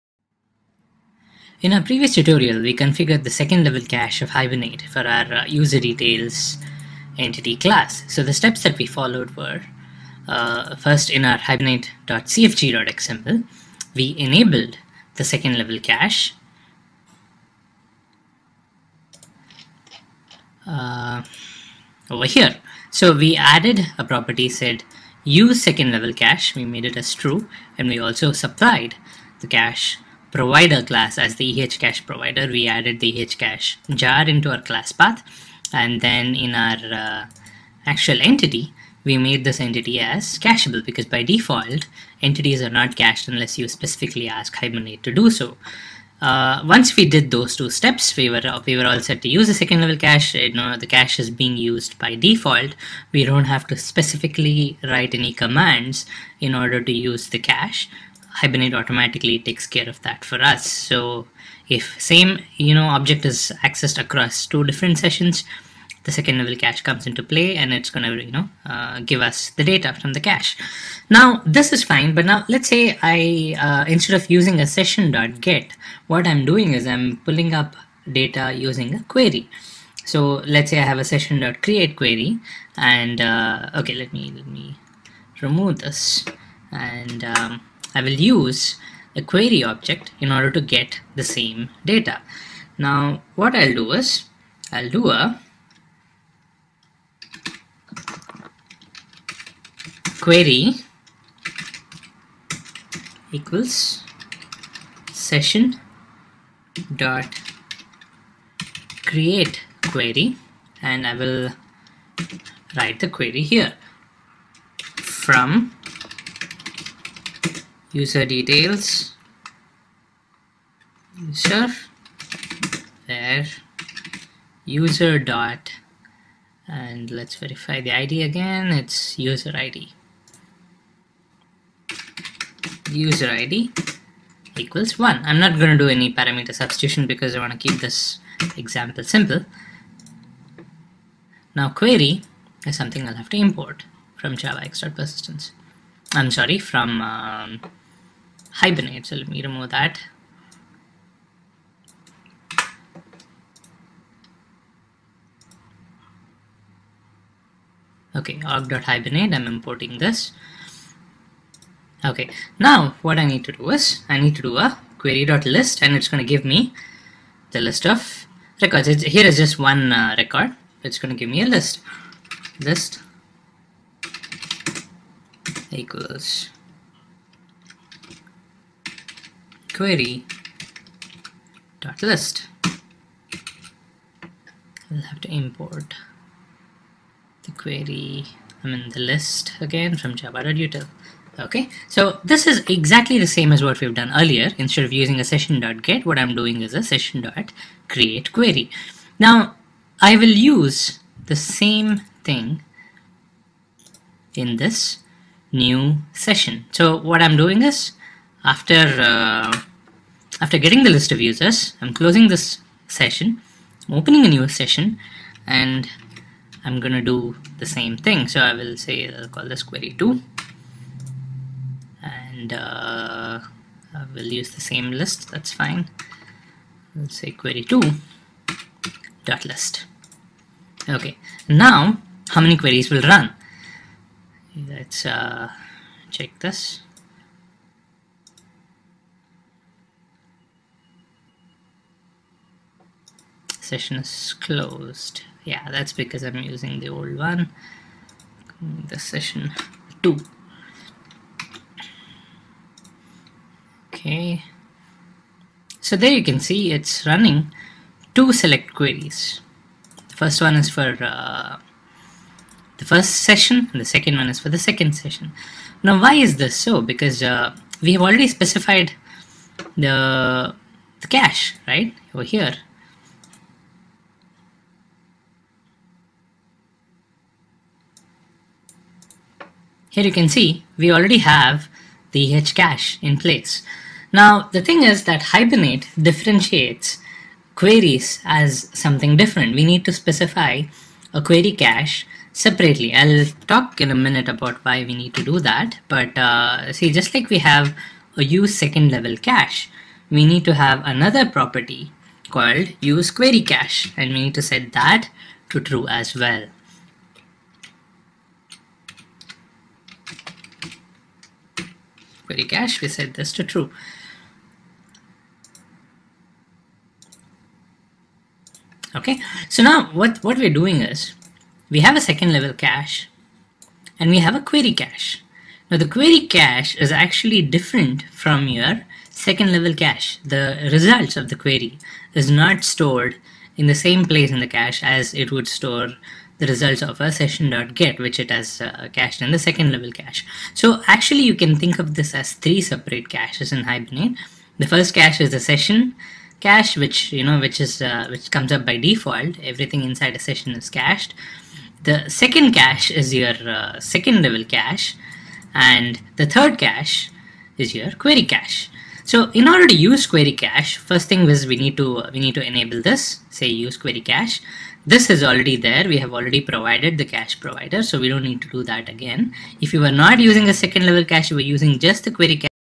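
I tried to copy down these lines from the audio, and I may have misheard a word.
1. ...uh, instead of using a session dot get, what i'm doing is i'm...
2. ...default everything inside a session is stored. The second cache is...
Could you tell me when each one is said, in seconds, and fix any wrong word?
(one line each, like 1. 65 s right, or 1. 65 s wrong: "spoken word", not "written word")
1. 73 s right
2. 348 s wrong: "cached", not "stored".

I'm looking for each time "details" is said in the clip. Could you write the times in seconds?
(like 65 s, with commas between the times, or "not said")
5 s, 118 s.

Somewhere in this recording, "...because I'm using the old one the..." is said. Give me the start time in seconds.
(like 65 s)
246 s.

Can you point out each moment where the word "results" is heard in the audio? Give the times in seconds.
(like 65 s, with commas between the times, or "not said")
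330 s, 336 s.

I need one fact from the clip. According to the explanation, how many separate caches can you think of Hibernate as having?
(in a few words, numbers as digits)
3.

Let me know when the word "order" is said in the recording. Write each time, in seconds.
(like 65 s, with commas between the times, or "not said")
56 s, 90 s, 359 s.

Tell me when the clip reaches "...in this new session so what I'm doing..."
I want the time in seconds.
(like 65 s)
204 s.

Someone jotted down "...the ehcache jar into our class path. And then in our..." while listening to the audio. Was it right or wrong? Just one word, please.
right.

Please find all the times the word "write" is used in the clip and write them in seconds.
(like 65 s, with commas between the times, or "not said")
54 s, 112 s.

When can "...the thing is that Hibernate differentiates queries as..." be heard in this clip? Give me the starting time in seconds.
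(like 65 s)
284 s.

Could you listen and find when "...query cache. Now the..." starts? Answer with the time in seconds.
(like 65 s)
324 s.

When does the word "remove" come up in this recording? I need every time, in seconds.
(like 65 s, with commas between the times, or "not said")
85 s, 149 s.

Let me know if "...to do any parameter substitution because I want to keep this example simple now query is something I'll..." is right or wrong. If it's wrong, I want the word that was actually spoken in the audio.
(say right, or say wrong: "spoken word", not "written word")
right.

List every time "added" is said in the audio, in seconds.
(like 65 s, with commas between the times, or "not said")
23 s, 32 s.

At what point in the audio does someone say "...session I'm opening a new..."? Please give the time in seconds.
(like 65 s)
212 s.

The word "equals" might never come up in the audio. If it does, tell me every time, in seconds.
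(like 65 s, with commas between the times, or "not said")
103 s, 134 s, 175 s.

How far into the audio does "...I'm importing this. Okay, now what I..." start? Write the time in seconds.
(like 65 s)
159 s.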